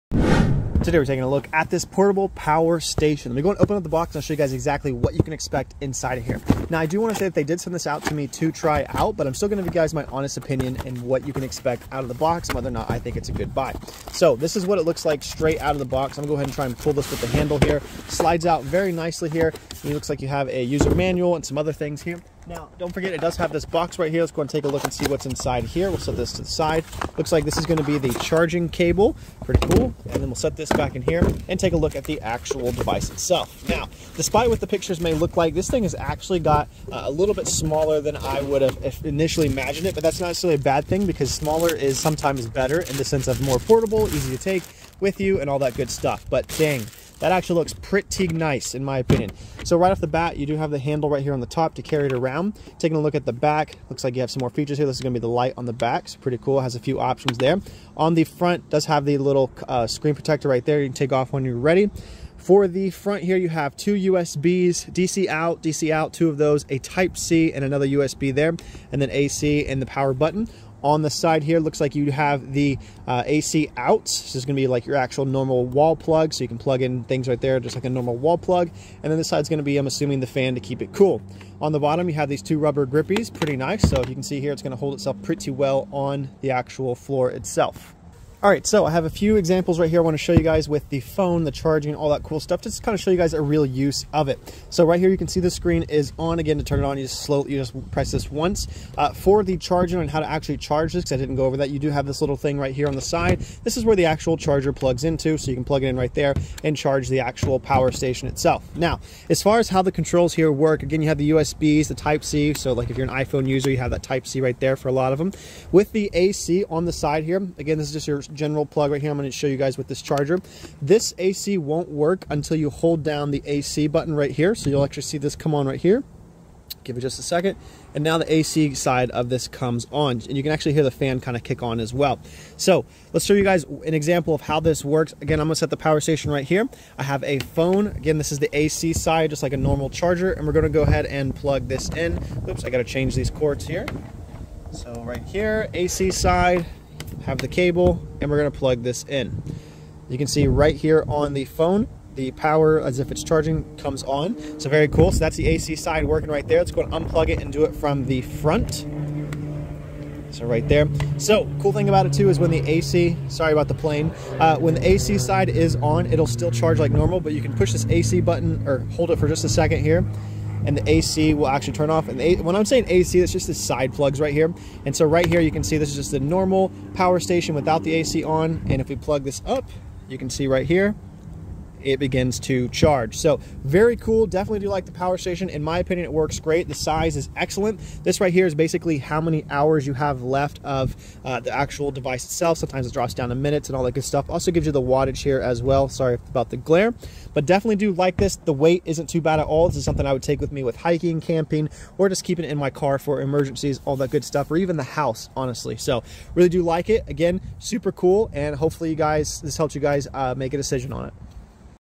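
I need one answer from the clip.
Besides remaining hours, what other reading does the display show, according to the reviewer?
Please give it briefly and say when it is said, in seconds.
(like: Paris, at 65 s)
wattage, at 194 s.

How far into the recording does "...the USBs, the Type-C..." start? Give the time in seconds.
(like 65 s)
111 s.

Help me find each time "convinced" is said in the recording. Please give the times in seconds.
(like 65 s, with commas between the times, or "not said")
not said.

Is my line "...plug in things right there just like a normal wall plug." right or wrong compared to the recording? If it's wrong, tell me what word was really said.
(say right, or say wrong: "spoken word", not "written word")
right.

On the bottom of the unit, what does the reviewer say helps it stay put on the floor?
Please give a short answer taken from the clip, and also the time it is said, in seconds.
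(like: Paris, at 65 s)
two rubber grippies, at 82 s.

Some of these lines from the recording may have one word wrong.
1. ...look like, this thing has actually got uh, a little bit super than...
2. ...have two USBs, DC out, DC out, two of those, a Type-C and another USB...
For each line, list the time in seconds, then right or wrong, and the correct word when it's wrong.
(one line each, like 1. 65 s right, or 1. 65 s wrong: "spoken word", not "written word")
1. 35 s wrong: "smaller", not "super"
2. 63 s right.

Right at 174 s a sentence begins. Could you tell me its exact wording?
And so right here, you can see this is just the normal power station without the AC on.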